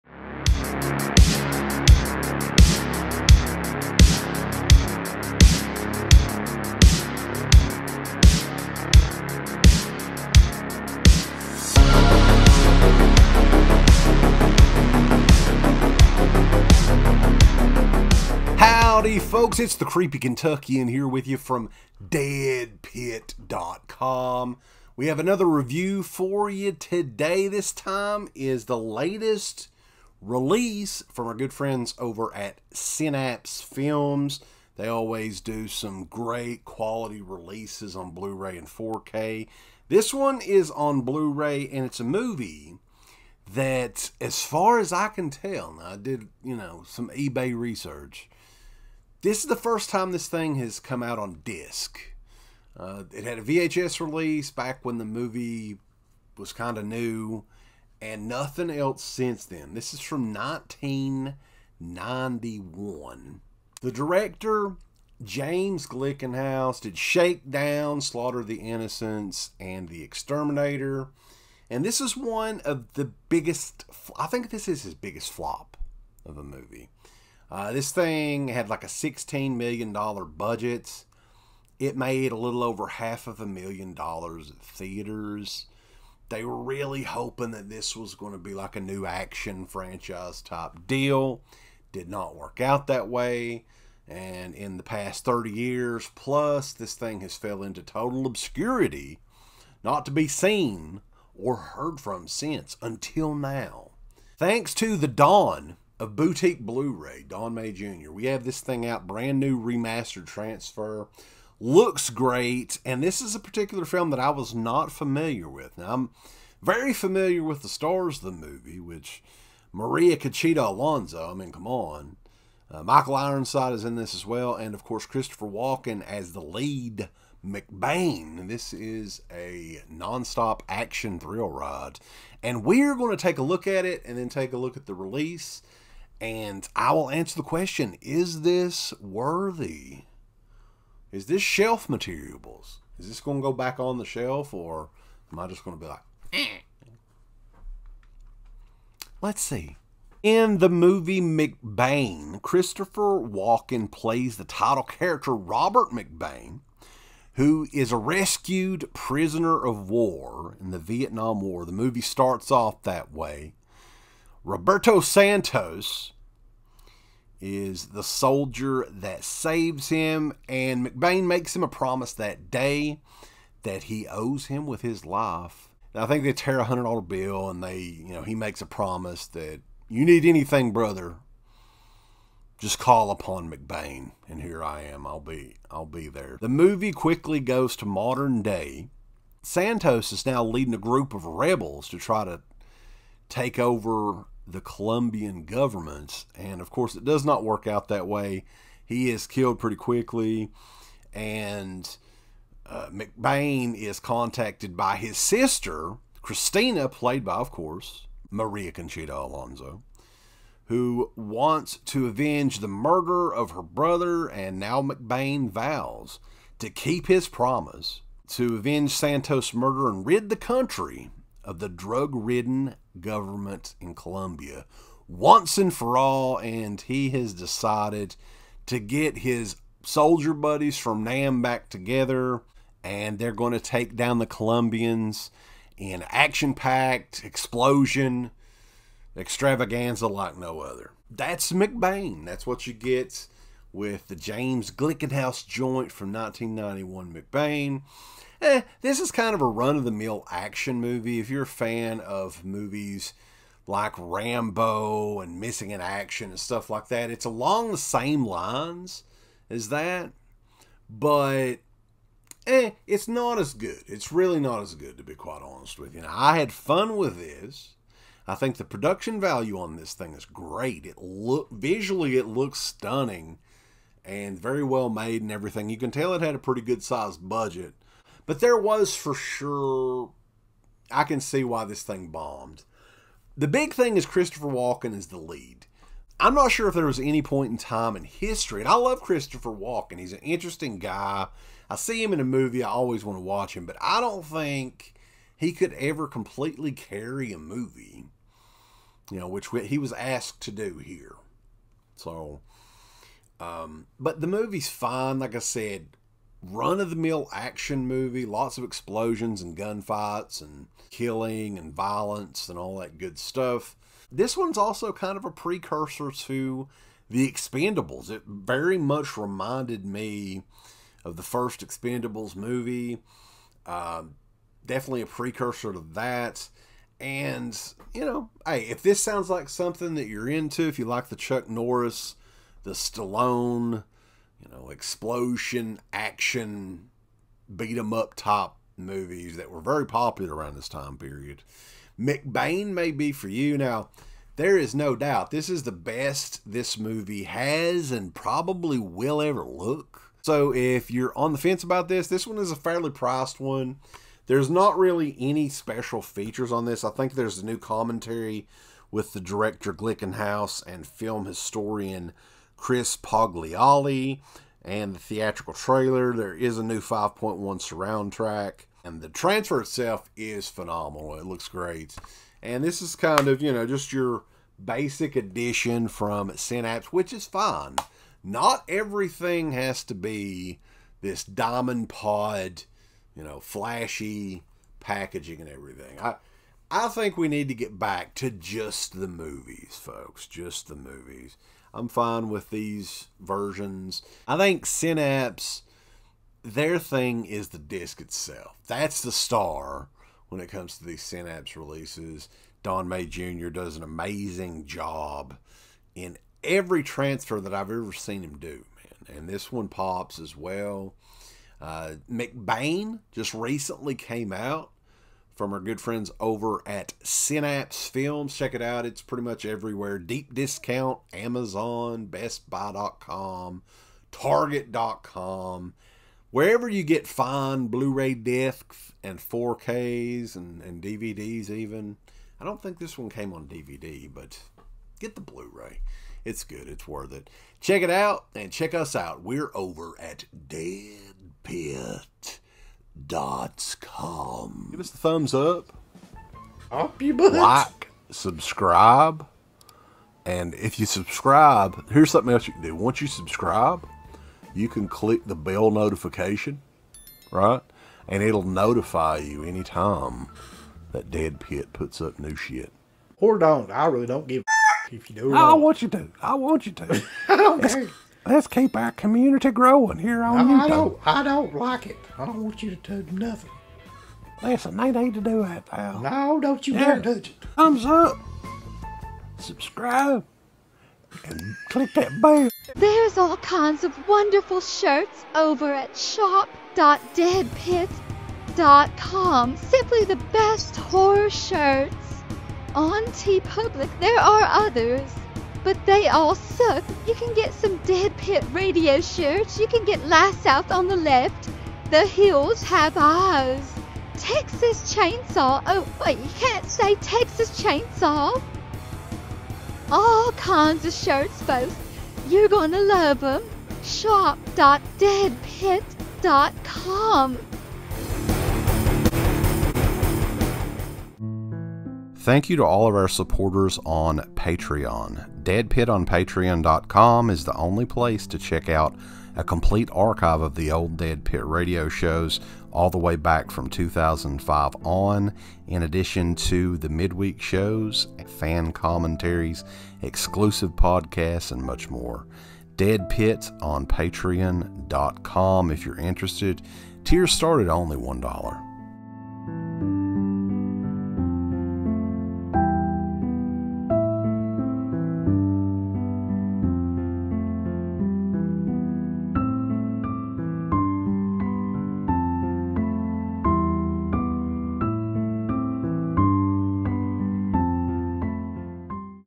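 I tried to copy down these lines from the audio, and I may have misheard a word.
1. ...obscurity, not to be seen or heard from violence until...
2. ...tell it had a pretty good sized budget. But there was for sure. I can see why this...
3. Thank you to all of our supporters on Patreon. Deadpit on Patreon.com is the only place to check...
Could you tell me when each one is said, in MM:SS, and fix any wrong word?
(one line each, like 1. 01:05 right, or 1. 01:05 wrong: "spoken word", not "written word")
1. 01:38 wrong: "since", not "violence"
2. 04:35 right
3. 08:42 right.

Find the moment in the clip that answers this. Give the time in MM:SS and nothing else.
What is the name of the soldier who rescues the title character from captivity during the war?
02:44.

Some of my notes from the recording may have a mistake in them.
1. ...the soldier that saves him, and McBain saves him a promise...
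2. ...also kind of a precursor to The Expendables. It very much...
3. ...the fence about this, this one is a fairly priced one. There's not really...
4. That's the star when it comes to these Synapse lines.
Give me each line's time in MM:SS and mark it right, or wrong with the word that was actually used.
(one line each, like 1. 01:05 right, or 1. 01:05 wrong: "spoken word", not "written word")
1. 02:47 wrong: "makes", not "saves"
2. 05:14 right
3. 05:51 right
4. 06:38 wrong: "releases", not "lines".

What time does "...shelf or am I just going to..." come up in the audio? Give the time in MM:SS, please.
02:24.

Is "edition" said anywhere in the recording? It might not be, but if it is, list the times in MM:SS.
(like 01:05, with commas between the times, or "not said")
06:15.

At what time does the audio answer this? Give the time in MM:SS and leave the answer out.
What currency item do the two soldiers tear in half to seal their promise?
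02:56.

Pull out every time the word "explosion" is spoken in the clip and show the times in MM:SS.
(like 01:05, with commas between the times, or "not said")
03:57, 05:08, 05:34.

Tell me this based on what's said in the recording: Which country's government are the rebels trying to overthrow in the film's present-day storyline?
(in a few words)
Colombia.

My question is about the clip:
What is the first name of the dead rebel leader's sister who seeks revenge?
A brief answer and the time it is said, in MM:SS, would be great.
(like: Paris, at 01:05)
Christina, at 03:26.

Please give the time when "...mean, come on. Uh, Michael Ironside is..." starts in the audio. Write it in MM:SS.
02:01.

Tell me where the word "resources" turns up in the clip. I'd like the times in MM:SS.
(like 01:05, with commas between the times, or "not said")
not said.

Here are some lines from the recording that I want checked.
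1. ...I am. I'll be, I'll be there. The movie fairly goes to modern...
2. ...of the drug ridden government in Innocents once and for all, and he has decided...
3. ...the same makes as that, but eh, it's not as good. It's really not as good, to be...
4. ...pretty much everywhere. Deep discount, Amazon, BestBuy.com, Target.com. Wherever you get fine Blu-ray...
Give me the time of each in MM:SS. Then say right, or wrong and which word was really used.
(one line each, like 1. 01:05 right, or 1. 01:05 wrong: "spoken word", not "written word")
1. 03:04 wrong: "quickly", not "fairly"
2. 03:41 wrong: "Colombia", not "Innocents"
3. 04:17 wrong: "lines", not "makes"
4. 06:59 right.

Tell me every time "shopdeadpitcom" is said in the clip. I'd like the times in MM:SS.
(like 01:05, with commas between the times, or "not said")
08:05, 08:33.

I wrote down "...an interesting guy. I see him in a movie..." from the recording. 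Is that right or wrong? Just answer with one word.
right.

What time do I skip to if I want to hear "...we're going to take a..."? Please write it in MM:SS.
02:12.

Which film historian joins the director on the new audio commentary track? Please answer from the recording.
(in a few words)
Chris Poggiali.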